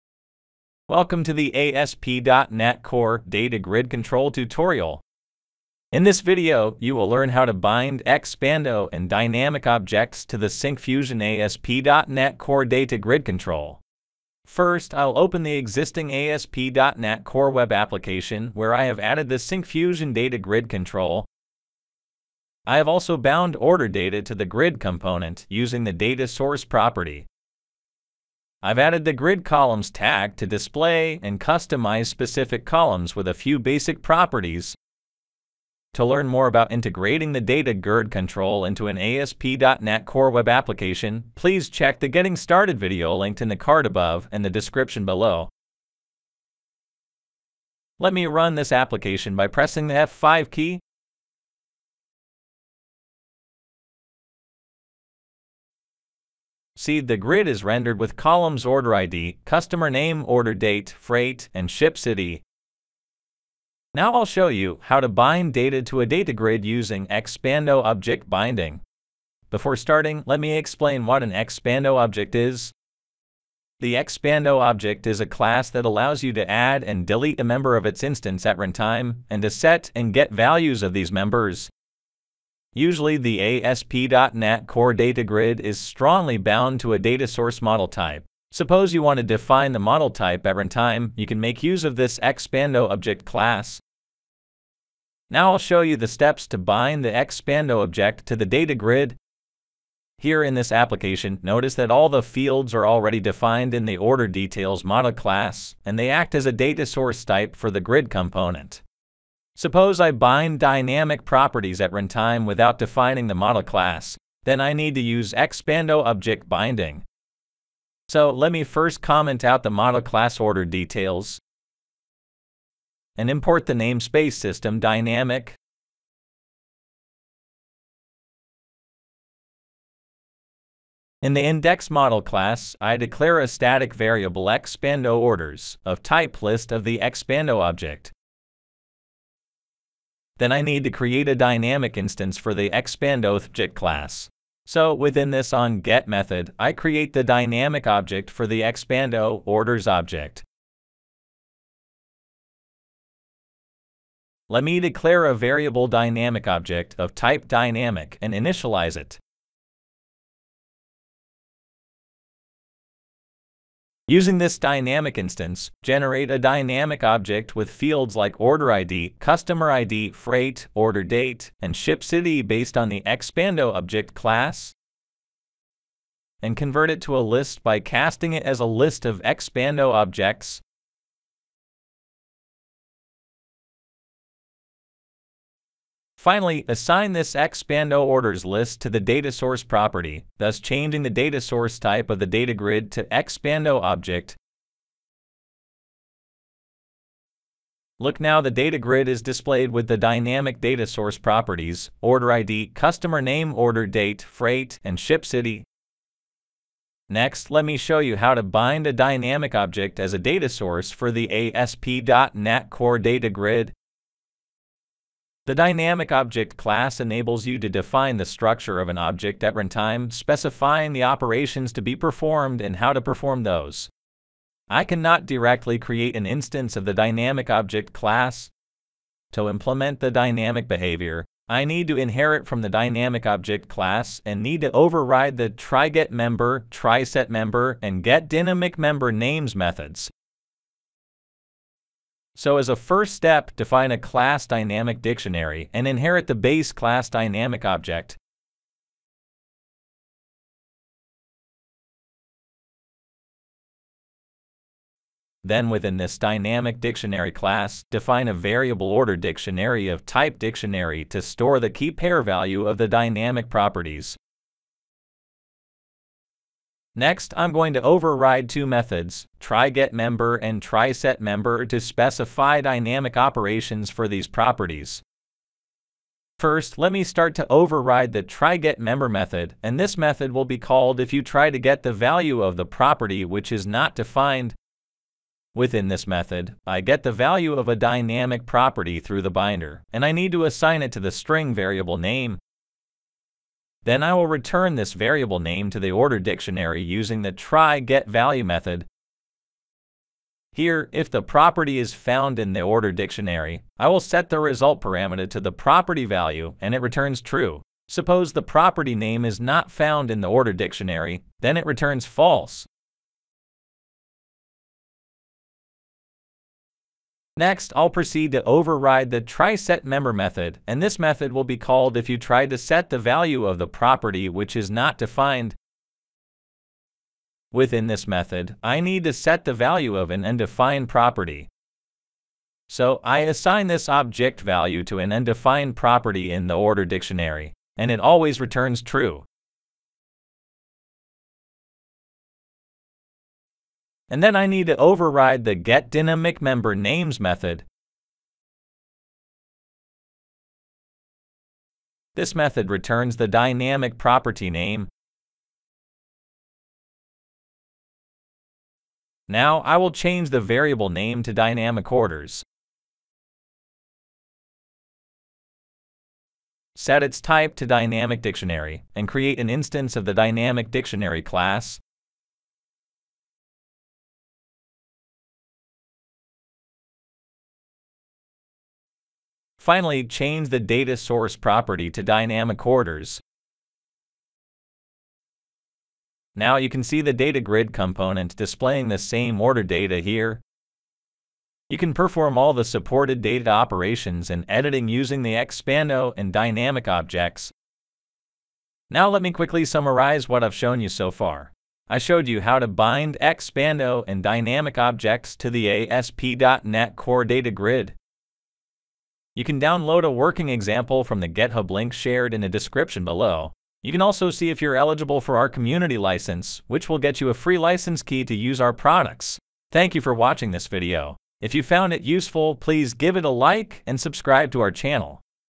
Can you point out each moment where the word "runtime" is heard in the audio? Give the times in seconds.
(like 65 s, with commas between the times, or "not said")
78 s, 90 s, 111 s, 219 s.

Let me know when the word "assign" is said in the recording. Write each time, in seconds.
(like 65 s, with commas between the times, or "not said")
186 s, 290 s, 333 s.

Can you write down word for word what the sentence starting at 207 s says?
Next, let me show you how to bind a dynamic object as a data source for the ASP.NET Core data grid.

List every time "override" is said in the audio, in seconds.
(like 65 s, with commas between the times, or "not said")
234 s, 267 s, 277 s, 318 s, 344 s.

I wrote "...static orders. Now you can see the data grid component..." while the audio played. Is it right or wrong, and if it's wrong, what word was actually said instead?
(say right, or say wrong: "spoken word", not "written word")
wrong: "dynamic", not "static".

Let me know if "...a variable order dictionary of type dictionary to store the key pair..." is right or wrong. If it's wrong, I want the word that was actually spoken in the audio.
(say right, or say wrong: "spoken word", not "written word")
right.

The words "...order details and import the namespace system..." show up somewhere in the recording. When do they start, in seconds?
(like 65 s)
120 s.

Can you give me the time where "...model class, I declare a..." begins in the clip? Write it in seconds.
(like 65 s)
131 s.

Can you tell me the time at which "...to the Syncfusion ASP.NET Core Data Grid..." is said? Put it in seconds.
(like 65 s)
10 s.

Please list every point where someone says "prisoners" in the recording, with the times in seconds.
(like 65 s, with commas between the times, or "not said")
not said.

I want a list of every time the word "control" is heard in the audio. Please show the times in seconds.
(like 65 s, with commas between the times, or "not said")
3 s, 13 s, 20 s, 38 s.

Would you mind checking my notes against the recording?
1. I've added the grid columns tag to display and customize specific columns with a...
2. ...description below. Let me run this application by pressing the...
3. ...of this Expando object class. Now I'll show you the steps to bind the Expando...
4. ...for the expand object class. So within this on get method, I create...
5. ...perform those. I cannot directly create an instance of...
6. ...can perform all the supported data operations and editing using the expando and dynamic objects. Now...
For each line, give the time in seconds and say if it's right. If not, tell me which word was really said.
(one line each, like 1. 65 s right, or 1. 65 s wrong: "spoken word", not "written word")
1. 28 s right
2. 44 s right
3. 91 s right
4. 142 s right
5. 223 s right
6. 391 s right.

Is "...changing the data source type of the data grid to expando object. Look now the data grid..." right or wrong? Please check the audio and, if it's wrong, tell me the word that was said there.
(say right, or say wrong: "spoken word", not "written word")
right.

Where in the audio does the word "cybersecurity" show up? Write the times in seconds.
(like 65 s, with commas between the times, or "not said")
not said.